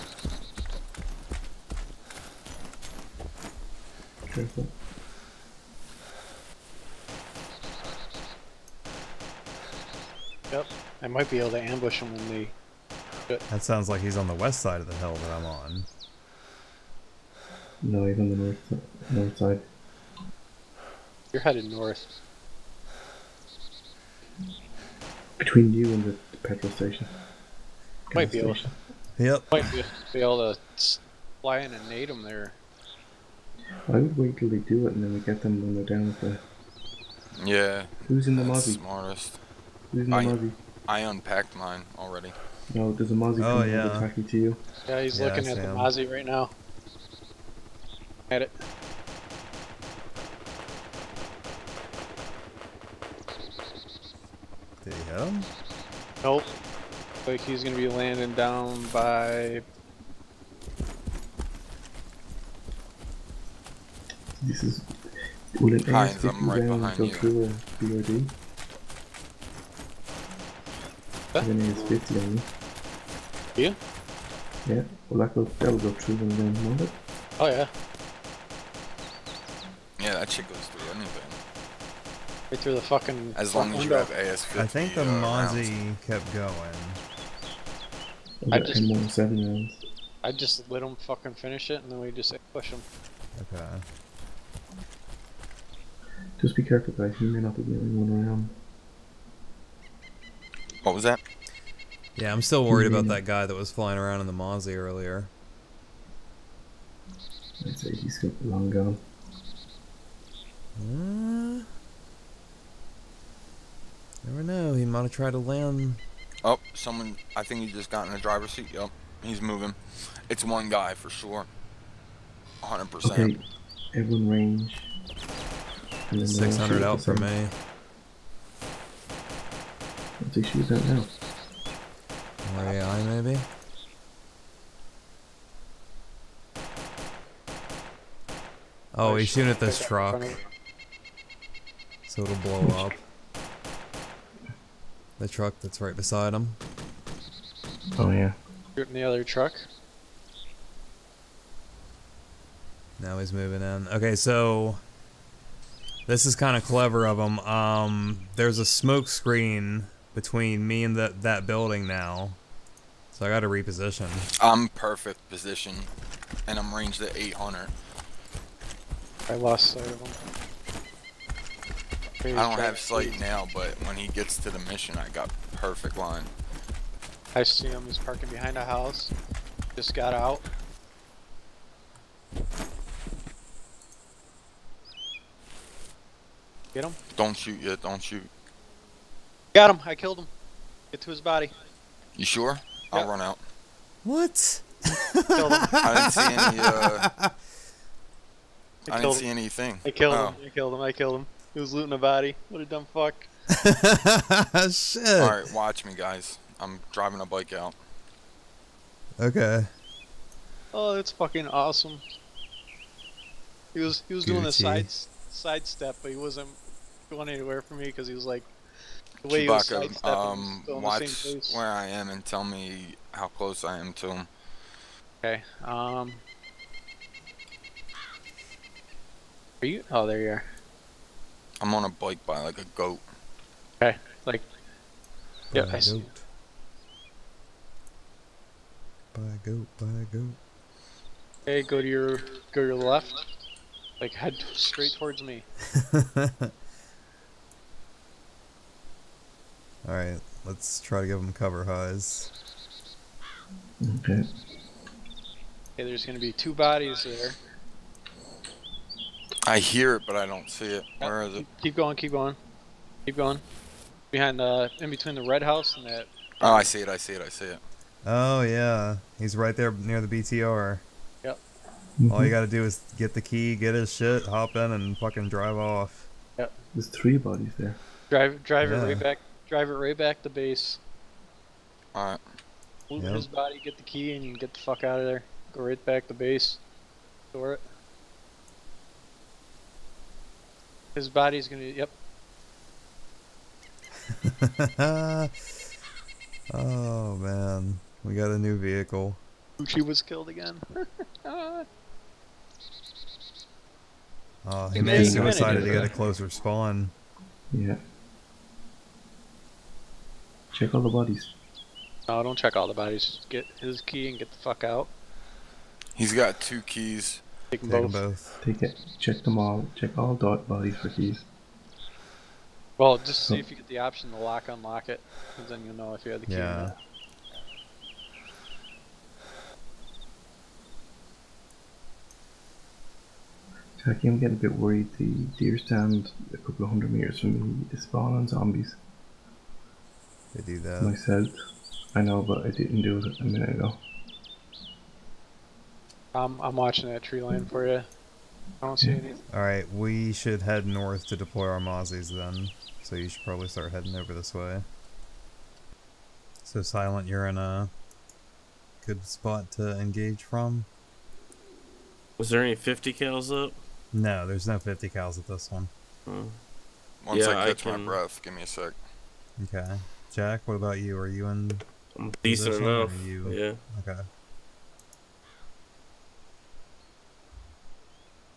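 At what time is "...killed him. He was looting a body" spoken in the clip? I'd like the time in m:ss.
3:20.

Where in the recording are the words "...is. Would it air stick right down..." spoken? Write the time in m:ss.
1:04.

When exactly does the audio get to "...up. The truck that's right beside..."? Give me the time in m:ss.
2:22.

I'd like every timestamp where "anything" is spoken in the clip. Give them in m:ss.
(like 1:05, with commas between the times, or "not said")
1:20, 3:19, 5:48.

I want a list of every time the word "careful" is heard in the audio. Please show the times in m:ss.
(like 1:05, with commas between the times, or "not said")
0:04, 1:36.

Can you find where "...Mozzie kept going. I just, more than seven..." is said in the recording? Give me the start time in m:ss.
1:25.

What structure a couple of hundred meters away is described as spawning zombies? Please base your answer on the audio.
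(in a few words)
The deer stand.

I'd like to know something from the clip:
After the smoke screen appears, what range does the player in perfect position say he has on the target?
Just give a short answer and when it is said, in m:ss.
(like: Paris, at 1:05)
800, at 2:47.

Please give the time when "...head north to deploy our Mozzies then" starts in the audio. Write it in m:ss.
5:50.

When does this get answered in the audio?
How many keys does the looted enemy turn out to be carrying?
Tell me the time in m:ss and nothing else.
5:16.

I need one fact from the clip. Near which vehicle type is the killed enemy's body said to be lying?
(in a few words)
BTR.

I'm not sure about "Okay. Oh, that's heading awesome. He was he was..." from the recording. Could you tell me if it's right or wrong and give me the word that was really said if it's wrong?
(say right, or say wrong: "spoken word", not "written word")
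wrong: "fucking", not "heading".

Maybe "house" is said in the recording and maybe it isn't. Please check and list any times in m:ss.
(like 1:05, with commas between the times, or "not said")
2:58, 4:25.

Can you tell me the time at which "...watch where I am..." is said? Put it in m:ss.
3:40.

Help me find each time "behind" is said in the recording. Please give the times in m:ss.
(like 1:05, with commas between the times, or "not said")
2:58, 4:24.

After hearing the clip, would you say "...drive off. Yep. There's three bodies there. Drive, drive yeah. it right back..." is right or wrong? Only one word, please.
right.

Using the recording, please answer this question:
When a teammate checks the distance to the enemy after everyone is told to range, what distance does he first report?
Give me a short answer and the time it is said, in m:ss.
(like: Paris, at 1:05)
600, at 2:06.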